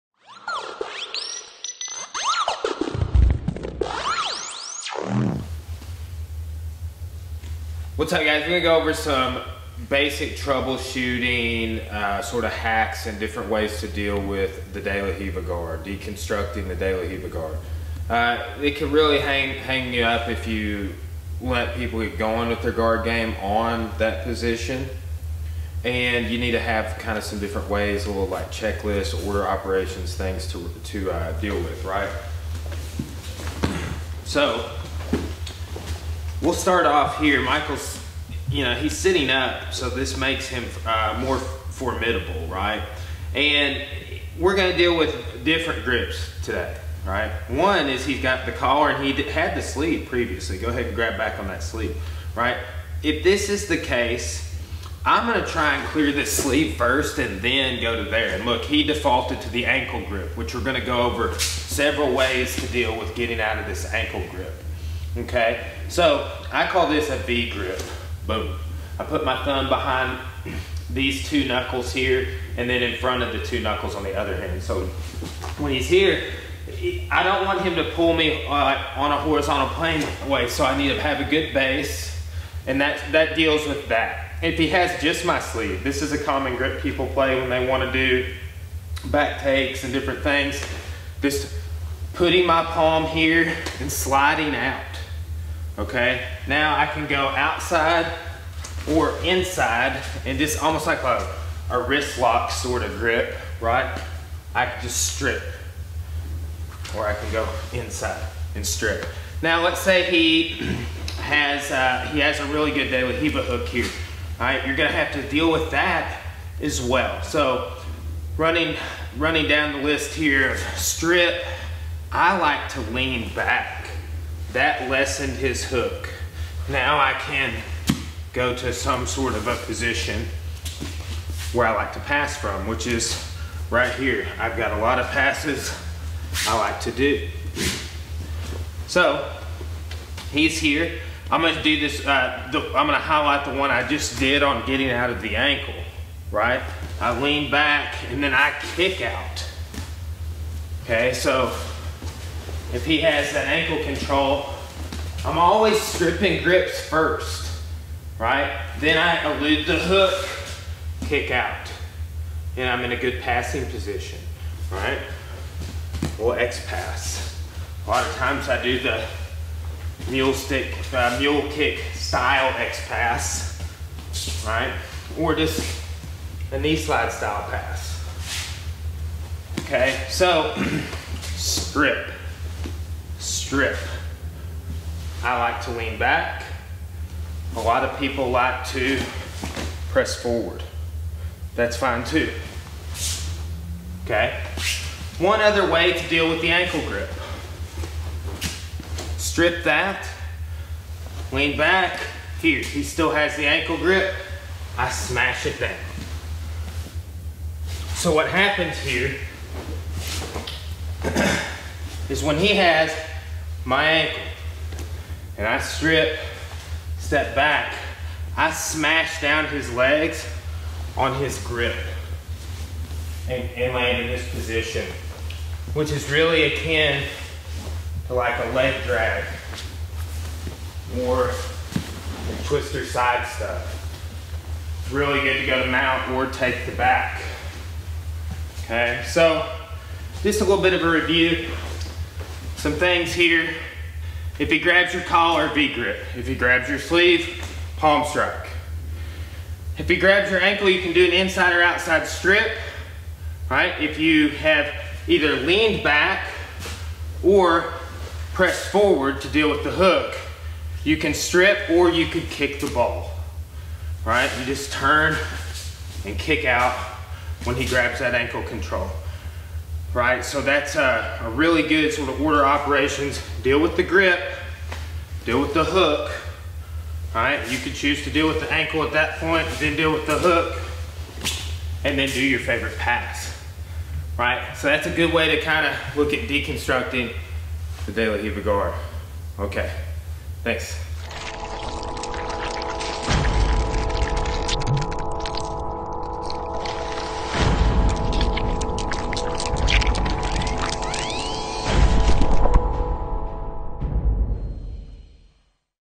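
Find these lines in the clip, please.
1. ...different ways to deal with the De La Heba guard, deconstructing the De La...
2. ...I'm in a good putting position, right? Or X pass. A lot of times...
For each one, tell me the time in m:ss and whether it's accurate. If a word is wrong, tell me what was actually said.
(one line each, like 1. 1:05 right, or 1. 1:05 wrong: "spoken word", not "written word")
1. 0:13 wrong: "Riva", not "Heba"
2. 2:42 wrong: "passing", not "putting".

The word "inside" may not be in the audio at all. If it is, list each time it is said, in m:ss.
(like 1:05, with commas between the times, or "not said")
1:39, 1:47, 4:11.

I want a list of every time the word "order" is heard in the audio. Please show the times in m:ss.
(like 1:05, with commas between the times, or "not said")
0:29, 4:32.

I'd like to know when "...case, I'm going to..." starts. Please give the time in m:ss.
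0:53.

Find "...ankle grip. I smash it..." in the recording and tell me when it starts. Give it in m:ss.
3:23.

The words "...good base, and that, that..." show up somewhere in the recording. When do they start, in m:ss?
1:21.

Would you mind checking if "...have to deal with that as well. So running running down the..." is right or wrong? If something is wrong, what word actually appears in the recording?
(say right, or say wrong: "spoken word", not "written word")
right.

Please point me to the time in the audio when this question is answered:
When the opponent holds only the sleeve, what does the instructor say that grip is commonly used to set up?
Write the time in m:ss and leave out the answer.
1:29.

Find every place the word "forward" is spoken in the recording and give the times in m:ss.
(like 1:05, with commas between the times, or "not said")
3:10, 4:18.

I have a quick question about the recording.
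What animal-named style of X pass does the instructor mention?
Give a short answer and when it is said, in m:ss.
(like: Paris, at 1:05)
Mule kick, at 2:51.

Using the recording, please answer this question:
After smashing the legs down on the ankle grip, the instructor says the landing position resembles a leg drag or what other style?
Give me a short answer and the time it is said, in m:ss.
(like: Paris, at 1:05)
Twister side, at 3:52.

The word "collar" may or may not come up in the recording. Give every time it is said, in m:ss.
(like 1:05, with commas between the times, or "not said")
0:48, 4:05.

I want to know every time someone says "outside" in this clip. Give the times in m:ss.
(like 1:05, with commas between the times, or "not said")
1:37, 4:11.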